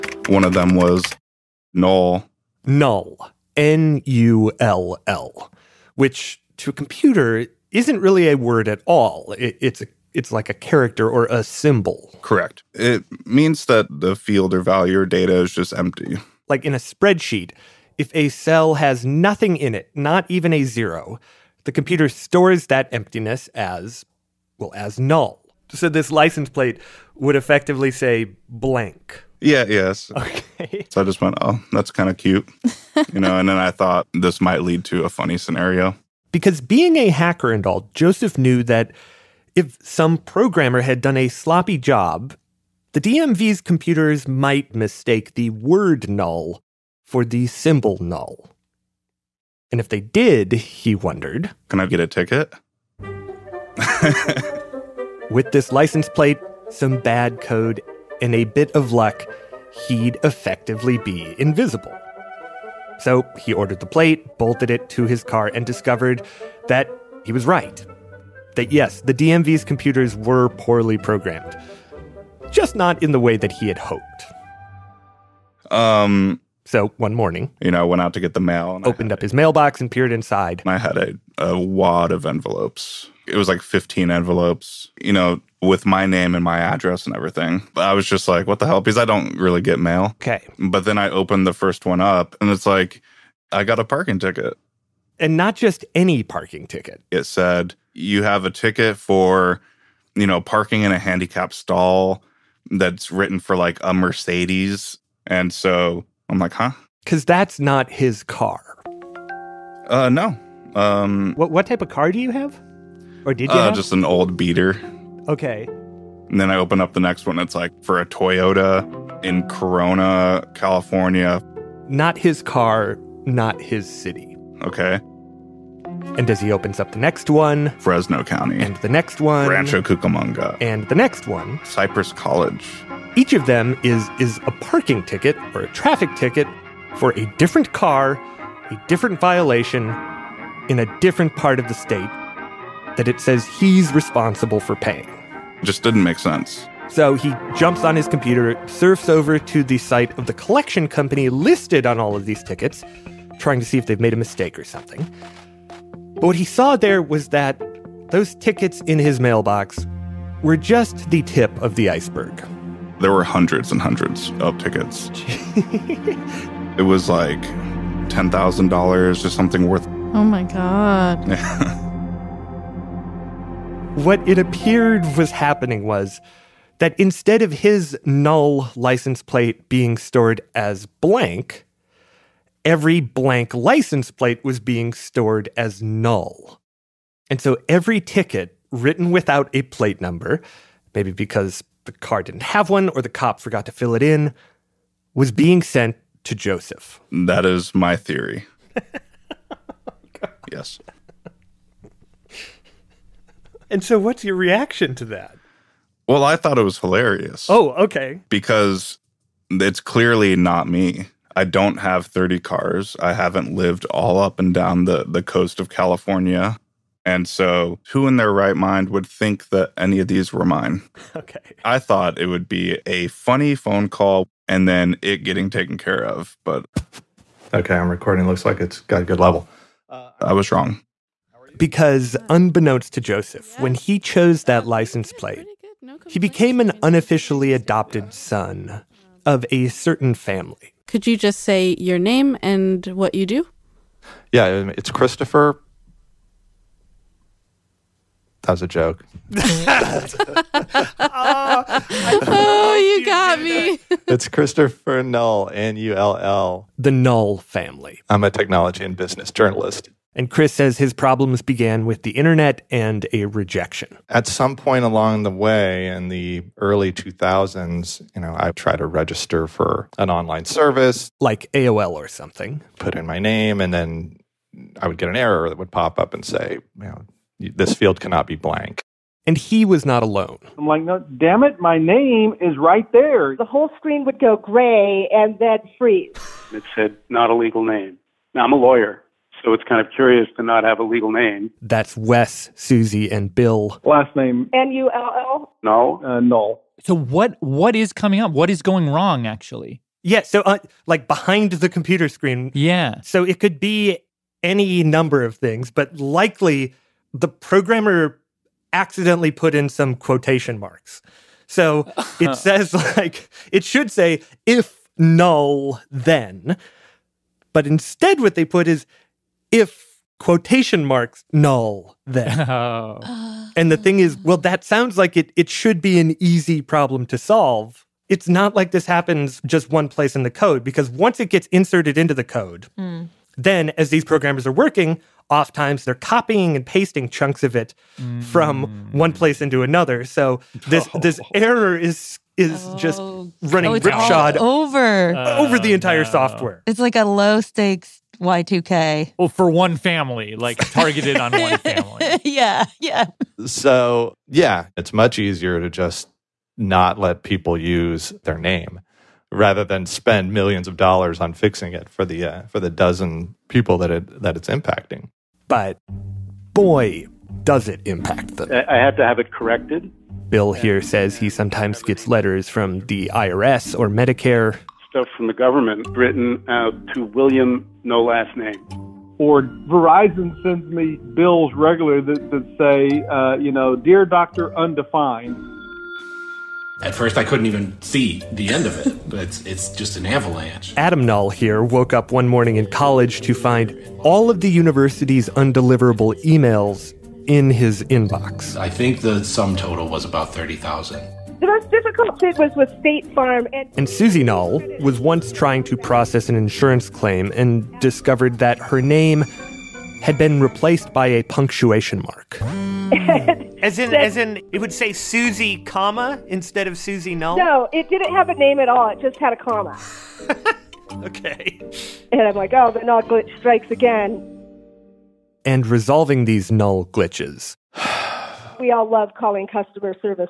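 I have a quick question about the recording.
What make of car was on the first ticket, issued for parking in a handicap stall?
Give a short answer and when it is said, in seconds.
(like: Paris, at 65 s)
Mercedes, at 103 s.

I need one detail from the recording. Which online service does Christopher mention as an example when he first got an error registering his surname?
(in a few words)
AOL.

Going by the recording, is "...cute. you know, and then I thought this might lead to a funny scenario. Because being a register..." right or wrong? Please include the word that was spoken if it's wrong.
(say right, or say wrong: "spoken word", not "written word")
wrong: "hacker", not "register".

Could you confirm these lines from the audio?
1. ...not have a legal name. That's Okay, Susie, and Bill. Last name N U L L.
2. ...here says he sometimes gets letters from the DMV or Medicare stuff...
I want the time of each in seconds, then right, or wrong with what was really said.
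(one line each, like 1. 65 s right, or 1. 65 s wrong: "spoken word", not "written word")
1. 290 s wrong: "Wes", not "Okay"
2. 370 s wrong: "IRS", not "DMV".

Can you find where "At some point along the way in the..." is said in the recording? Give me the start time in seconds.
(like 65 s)
264 s.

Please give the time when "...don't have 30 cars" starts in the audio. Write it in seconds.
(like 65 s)
211 s.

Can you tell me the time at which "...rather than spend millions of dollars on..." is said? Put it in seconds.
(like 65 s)
359 s.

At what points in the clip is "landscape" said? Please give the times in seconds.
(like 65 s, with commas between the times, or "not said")
not said.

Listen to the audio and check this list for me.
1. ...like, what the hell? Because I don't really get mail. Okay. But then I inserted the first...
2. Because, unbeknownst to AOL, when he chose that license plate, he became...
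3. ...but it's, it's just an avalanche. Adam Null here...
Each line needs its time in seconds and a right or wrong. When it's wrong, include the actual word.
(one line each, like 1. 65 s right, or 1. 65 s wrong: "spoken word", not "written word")
1. 88 s wrong: "opened", not "inserted"
2. 231 s wrong: "Joseph", not "AOL"
3. 389 s right.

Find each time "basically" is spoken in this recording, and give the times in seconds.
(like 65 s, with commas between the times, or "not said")
not said.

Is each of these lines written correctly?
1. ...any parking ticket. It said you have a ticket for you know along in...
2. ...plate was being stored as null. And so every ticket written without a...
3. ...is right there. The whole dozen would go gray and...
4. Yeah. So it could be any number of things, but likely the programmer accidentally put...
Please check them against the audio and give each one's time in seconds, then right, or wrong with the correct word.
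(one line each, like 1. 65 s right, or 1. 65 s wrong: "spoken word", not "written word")
1. 95 s wrong: "parking", not "along"
2. 184 s right
3. 282 s wrong: "screen", not "dozen"
4. 302 s right.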